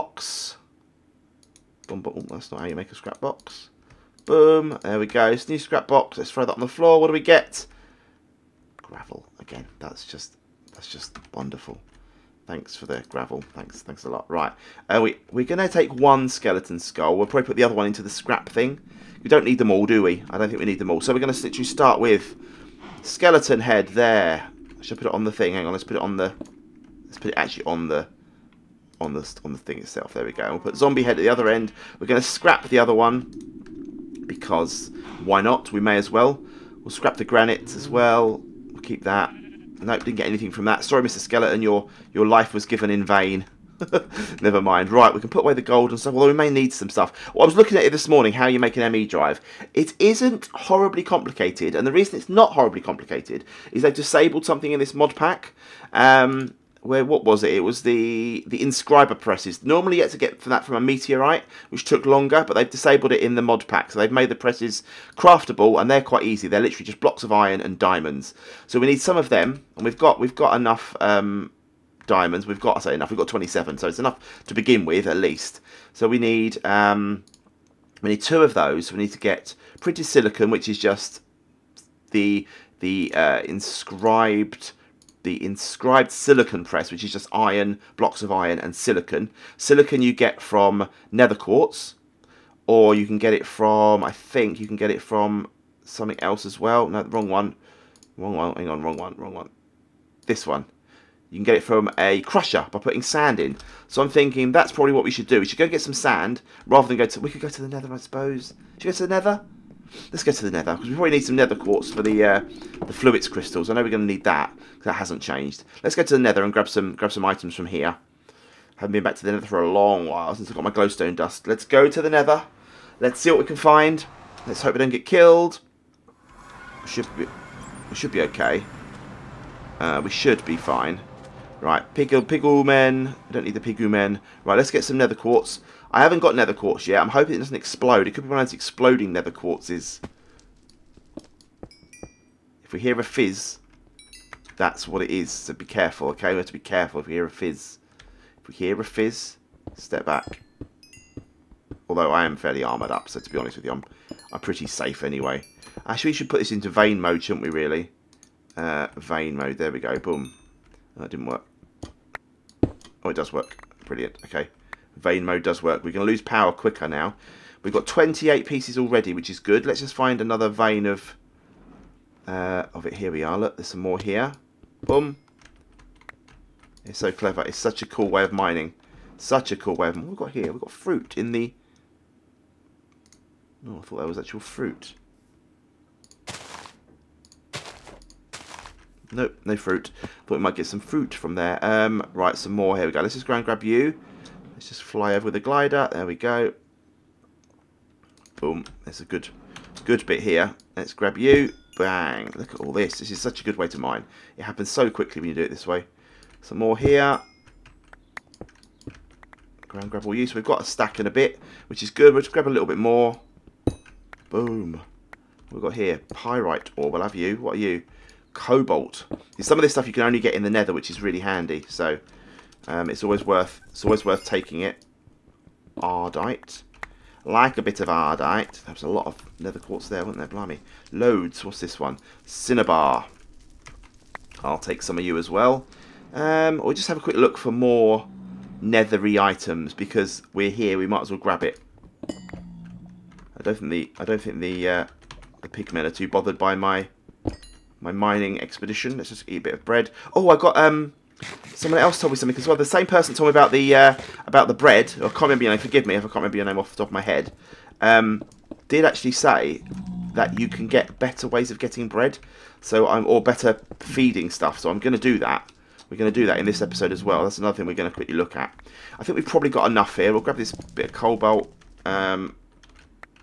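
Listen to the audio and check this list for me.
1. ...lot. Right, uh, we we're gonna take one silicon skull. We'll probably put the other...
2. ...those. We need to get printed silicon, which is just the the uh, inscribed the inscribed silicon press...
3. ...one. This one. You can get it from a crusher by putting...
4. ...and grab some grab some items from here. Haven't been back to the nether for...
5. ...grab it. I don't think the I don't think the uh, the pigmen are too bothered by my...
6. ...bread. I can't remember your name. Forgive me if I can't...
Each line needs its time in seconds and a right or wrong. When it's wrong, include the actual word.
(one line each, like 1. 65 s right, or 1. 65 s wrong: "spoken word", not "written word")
1. 14 s wrong: "skeleton", not "silicon"
2. 78 s right
3. 99 s right
4. 116 s right
5. 241 s right
6. 254 s right.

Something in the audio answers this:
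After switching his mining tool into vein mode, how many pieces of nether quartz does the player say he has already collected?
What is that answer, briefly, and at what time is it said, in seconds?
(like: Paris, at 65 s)
28, at 167 s.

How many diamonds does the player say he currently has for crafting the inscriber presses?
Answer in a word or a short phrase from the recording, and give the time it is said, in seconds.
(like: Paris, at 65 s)
27, at 73 s.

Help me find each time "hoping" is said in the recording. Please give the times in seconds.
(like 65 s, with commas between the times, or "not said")
137 s.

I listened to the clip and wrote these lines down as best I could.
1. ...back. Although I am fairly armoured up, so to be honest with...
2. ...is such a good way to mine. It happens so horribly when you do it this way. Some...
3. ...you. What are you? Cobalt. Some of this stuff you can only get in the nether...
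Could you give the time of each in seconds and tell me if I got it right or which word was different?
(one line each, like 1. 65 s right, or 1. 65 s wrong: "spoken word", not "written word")
1. 150 s right
2. 203 s wrong: "quickly", not "horribly"
3. 217 s right.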